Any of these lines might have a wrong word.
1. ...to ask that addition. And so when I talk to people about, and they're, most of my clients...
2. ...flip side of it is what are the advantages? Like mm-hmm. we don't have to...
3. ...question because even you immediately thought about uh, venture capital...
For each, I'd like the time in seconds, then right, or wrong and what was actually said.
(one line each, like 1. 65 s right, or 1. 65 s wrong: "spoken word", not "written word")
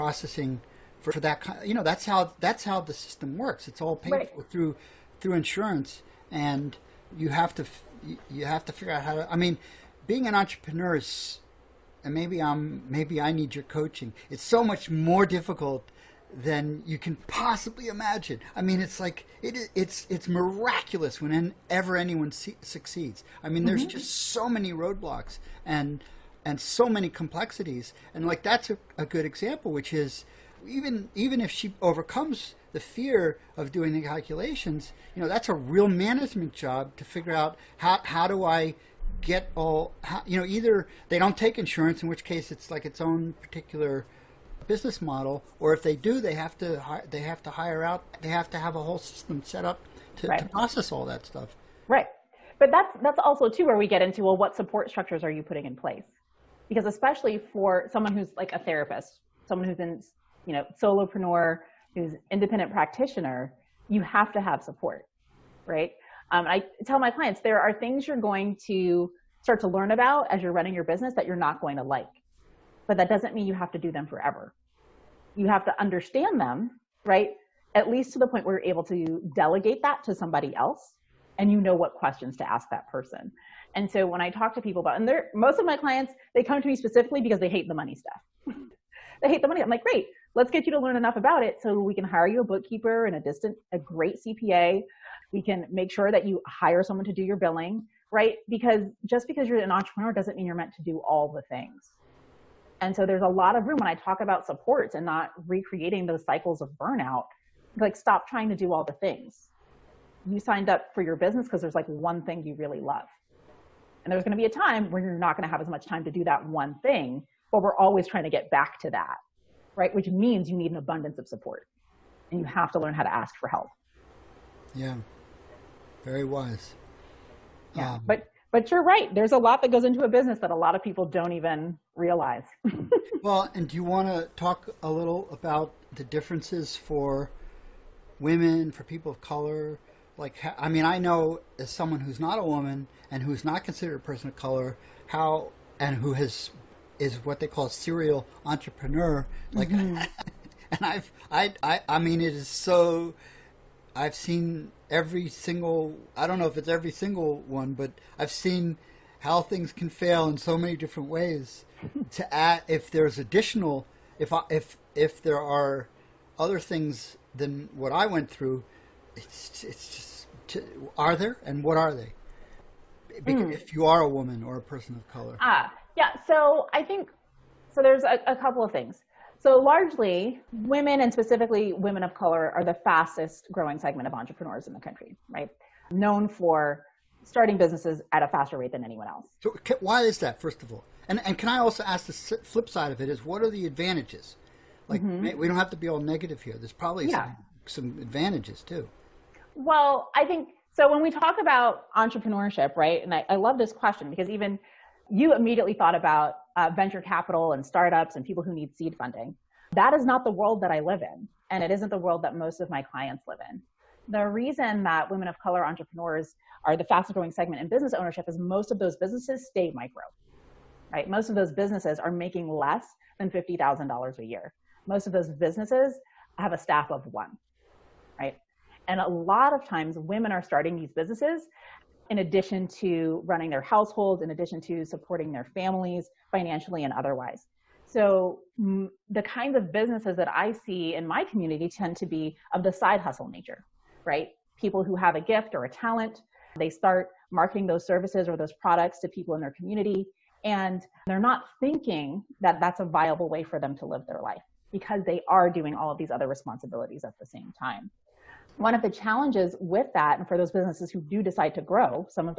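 1. 82 s wrong: "person", not "addition"
2. 192 s right
3. 203 s right.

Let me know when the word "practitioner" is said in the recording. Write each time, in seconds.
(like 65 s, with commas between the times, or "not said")
62 s.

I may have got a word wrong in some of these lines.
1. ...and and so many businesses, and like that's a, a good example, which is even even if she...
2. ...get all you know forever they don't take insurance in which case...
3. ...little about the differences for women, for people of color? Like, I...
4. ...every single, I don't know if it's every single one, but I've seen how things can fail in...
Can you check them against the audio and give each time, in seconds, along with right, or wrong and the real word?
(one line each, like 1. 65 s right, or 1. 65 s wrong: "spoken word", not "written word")
1. 25 s wrong: "complexities", not "businesses"
2. 39 s wrong: "either", not "forever"
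3. 134 s right
4. 154 s right.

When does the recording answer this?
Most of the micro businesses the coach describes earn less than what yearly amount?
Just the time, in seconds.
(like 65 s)
223 s.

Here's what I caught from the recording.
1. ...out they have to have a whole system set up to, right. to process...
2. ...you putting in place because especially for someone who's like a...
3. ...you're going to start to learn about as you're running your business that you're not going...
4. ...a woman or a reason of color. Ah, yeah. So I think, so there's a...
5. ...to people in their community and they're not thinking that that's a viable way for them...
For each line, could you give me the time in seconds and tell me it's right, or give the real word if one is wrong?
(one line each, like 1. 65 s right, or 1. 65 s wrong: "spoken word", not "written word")
1. 47 s right
2. 55 s right
3. 68 s right
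4. 174 s wrong: "person", not "reason"
5. 248 s right.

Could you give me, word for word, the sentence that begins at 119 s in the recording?
Which means you need an abundance of support and you have to learn how to ask for help.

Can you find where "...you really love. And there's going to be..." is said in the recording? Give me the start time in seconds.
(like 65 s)
112 s.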